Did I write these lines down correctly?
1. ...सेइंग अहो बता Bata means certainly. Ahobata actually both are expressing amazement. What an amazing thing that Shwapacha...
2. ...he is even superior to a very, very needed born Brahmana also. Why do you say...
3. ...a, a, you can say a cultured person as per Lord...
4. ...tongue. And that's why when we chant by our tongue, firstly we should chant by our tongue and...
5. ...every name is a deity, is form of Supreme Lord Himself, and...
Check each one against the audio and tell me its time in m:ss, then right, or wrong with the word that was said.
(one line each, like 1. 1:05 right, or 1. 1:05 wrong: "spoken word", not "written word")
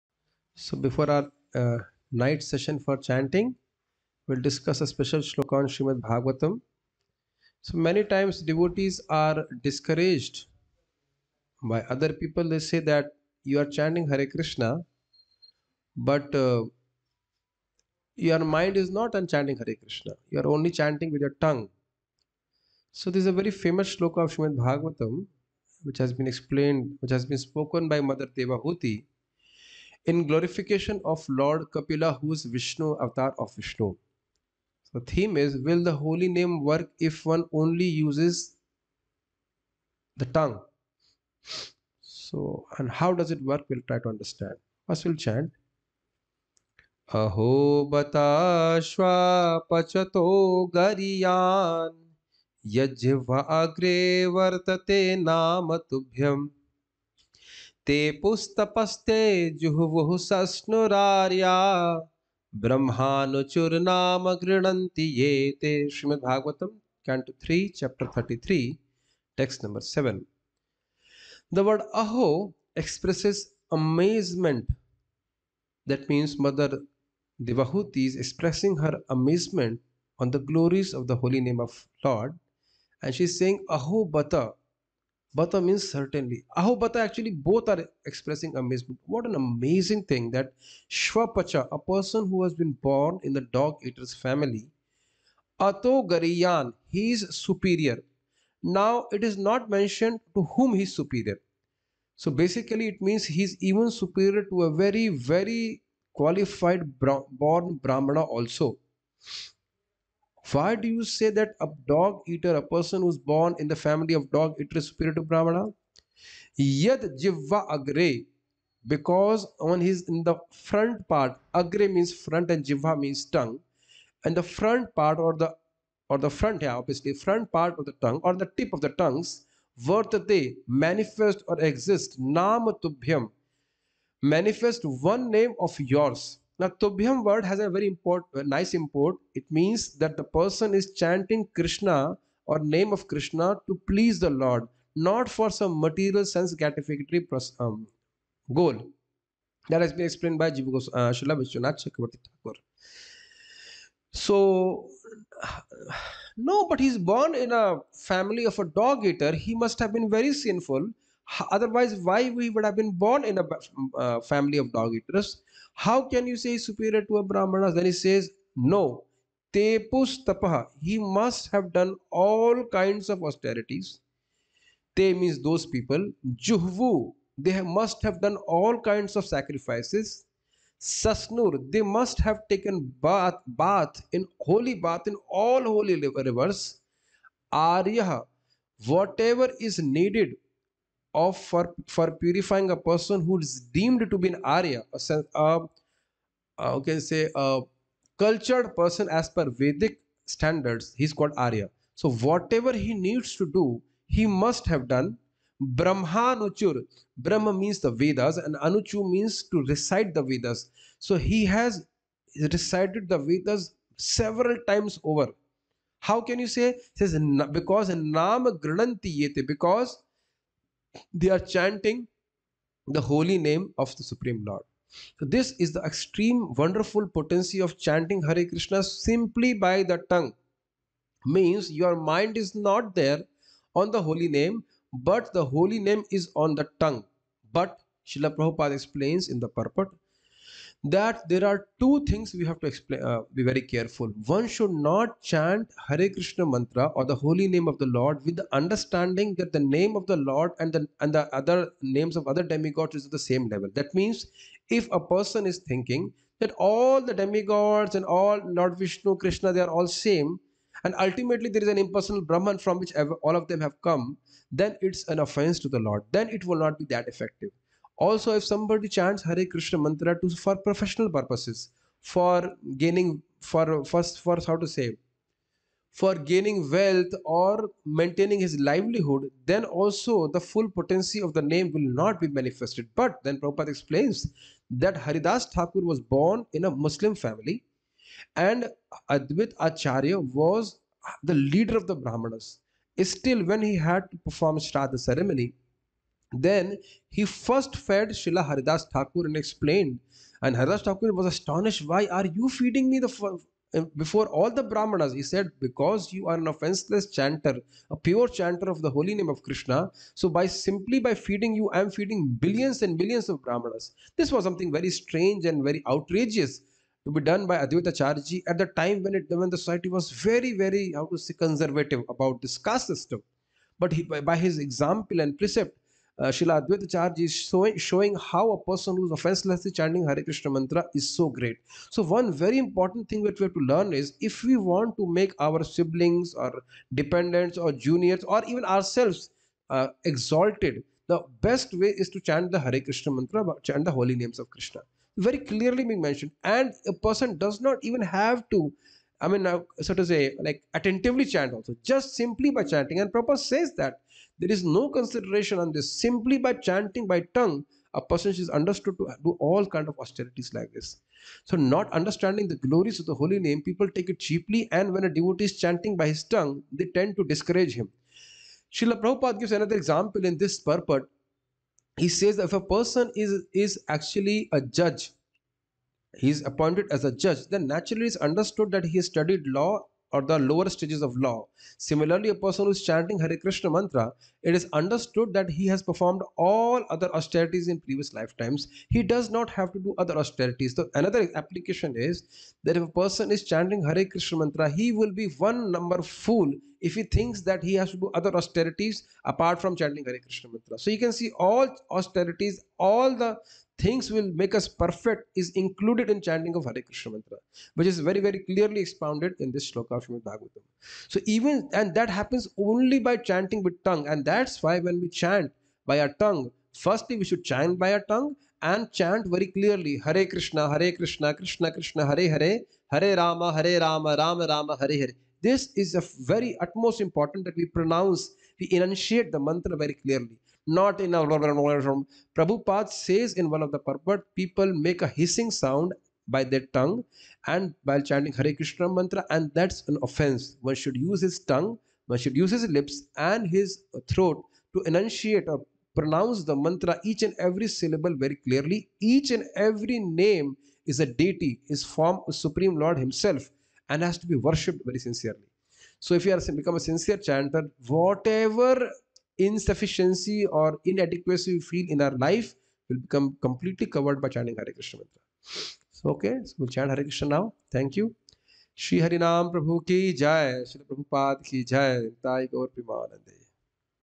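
1. 1:23 right
2. 1:43 wrong: "qualified", not "needed"
3. 3:15 wrong: "Vedic", not "Lord"
4. 6:53 right
5. 7:29 right.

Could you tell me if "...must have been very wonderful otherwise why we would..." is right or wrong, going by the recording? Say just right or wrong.
wrong.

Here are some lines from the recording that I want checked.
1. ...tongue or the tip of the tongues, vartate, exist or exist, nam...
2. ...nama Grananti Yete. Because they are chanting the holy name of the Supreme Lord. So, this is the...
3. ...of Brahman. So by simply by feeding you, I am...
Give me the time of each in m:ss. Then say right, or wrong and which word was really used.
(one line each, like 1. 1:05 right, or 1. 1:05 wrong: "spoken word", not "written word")
1. 2:08 wrong: "manifest", not "exist"
2. 3:37 right
3. 5:09 wrong: "Krishna", not "Brahman".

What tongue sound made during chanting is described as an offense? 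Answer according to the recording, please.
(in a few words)
Hissing sound.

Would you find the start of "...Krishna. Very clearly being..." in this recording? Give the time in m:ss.
5:44.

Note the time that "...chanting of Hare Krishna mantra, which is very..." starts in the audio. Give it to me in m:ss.
6:46.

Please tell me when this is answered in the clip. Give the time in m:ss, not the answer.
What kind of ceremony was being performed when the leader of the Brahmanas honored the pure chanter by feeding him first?
4:54.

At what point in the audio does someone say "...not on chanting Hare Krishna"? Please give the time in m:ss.
0:18.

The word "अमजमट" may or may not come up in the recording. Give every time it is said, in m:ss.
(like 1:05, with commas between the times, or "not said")
1:13, 1:19.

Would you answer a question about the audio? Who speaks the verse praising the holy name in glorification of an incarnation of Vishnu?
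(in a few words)
Mother Devahuti.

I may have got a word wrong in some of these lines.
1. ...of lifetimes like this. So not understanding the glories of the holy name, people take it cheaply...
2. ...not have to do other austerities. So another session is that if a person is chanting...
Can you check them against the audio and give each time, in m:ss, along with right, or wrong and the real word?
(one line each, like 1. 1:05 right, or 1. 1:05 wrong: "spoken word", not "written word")
1. 5:59 wrong: "austerities", not "lifetimes"
2. 6:29 wrong: "application", not "session".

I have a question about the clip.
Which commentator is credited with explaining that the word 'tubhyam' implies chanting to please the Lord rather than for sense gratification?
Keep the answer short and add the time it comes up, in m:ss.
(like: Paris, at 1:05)
Vishwanath Chakravarti Thakur, at 2:31.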